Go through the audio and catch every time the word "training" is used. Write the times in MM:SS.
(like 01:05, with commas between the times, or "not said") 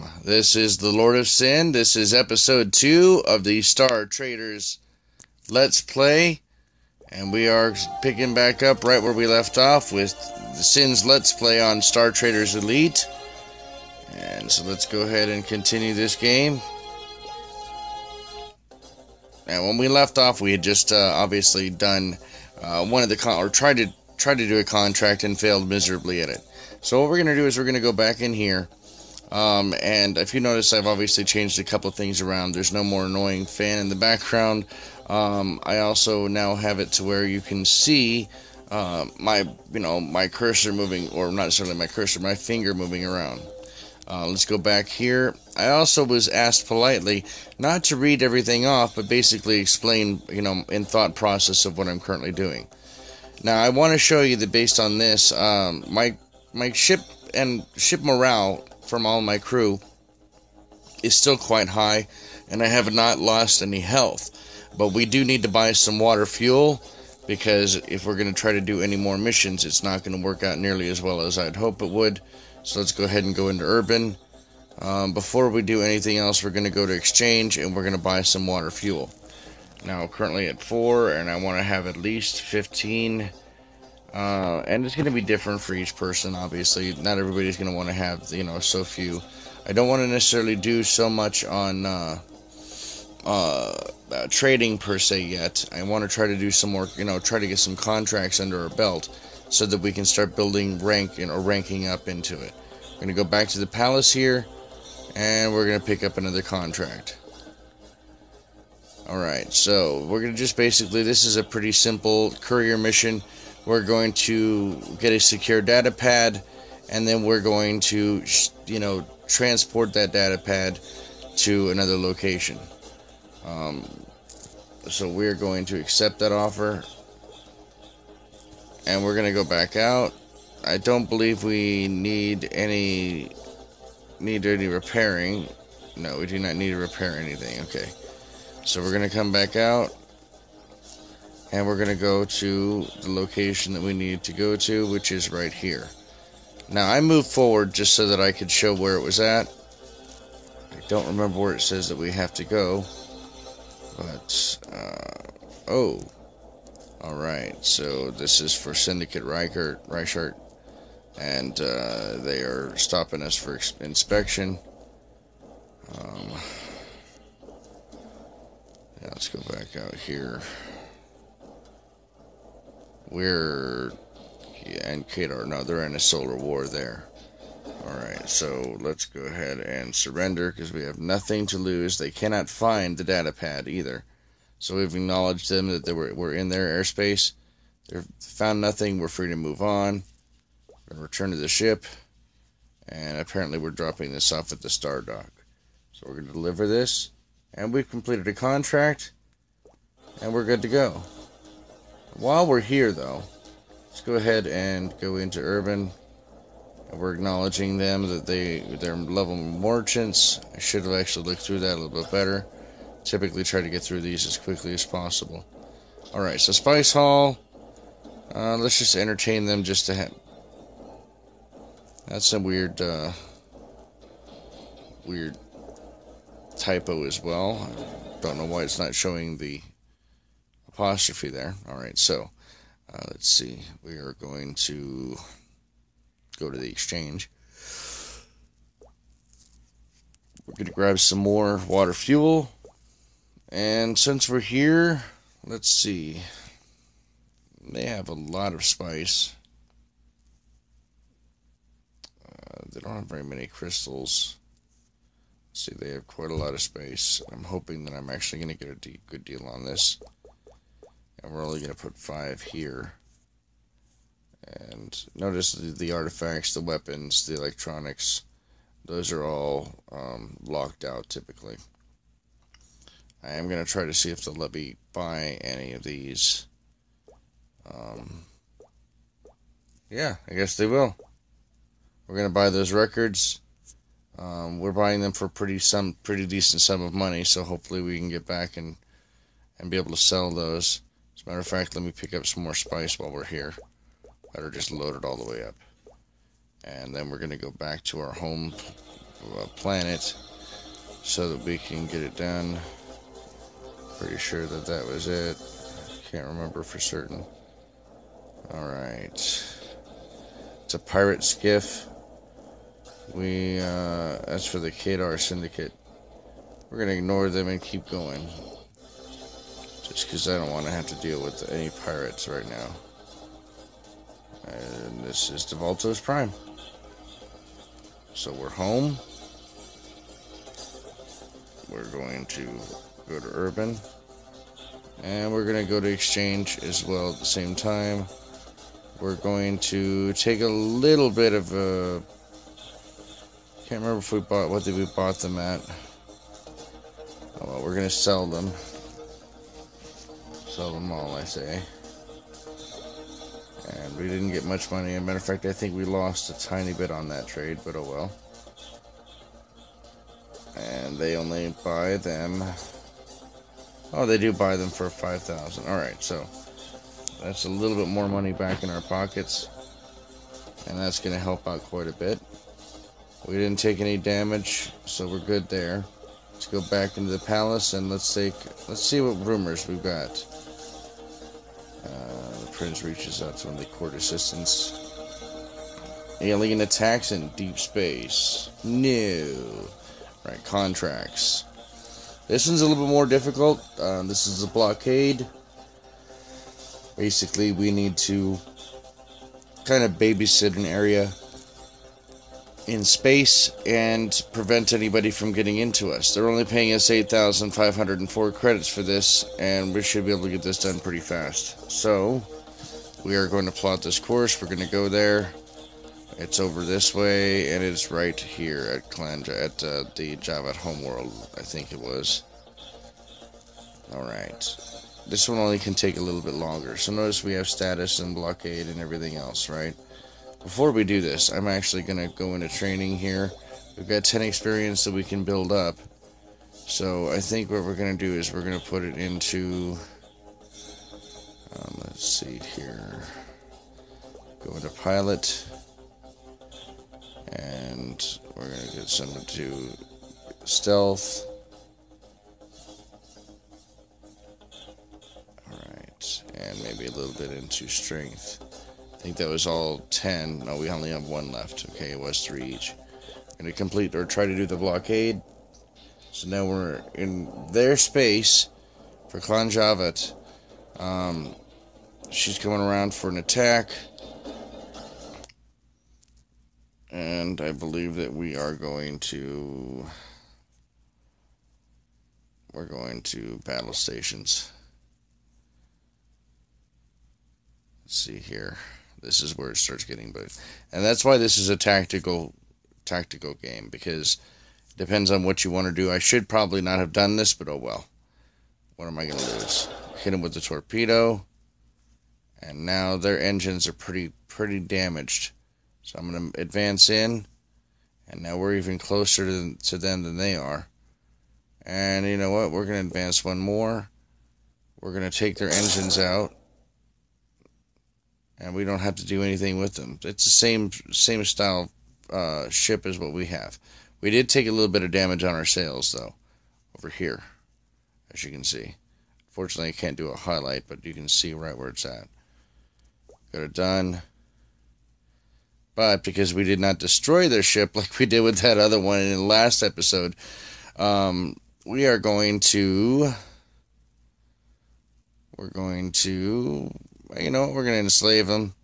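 07:12.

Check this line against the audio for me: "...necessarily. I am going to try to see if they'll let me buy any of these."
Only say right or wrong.
wrong.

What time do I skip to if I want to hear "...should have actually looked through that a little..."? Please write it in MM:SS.
03:30.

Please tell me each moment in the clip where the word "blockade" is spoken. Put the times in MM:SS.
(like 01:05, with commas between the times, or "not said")
06:34, 07:08, 07:44.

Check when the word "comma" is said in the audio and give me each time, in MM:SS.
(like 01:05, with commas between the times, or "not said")
not said.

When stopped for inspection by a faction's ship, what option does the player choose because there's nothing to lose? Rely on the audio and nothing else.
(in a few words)
Surrender.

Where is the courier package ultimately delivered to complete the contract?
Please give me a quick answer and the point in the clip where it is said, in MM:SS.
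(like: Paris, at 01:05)
Star dock, at 03:14.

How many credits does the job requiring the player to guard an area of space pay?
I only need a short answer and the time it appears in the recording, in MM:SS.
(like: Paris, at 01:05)
8,504 credits, at 06:46.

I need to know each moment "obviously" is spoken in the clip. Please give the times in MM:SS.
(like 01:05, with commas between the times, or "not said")
00:21, 00:30, 01:26.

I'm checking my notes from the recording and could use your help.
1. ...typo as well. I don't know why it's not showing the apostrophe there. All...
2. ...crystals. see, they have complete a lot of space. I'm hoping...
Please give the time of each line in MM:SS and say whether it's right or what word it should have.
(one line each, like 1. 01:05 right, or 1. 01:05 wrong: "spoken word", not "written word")
1. 03:46 right
2. 04:13 wrong: "quite", not "complete".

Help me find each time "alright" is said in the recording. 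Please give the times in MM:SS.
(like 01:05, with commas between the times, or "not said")
01:49, 02:37, 02:57, 05:08, 07:03, 07:35.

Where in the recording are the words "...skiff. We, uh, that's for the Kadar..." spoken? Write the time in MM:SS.
05:11.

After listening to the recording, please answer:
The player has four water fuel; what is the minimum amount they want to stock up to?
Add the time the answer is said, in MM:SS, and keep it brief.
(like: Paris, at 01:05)
15, at 01:22.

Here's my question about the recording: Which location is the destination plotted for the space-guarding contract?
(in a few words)
Calandra.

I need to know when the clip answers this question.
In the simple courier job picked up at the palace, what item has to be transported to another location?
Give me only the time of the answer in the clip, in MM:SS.
01:55.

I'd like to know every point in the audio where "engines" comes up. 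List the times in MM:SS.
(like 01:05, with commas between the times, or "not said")
08:23, 08:35.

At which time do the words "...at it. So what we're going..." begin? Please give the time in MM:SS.
00:26.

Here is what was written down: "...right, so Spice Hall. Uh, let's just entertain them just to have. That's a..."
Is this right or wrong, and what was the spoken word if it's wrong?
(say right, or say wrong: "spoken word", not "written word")
right.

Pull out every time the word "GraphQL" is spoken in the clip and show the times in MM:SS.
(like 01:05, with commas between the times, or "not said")
not said.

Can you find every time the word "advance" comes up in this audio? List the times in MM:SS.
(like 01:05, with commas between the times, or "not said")
08:26, 08:32.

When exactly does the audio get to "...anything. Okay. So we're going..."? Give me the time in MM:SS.
02:17.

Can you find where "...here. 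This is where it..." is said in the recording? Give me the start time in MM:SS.
08:08.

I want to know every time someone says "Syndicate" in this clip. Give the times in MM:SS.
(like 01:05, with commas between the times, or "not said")
02:38, 05:15.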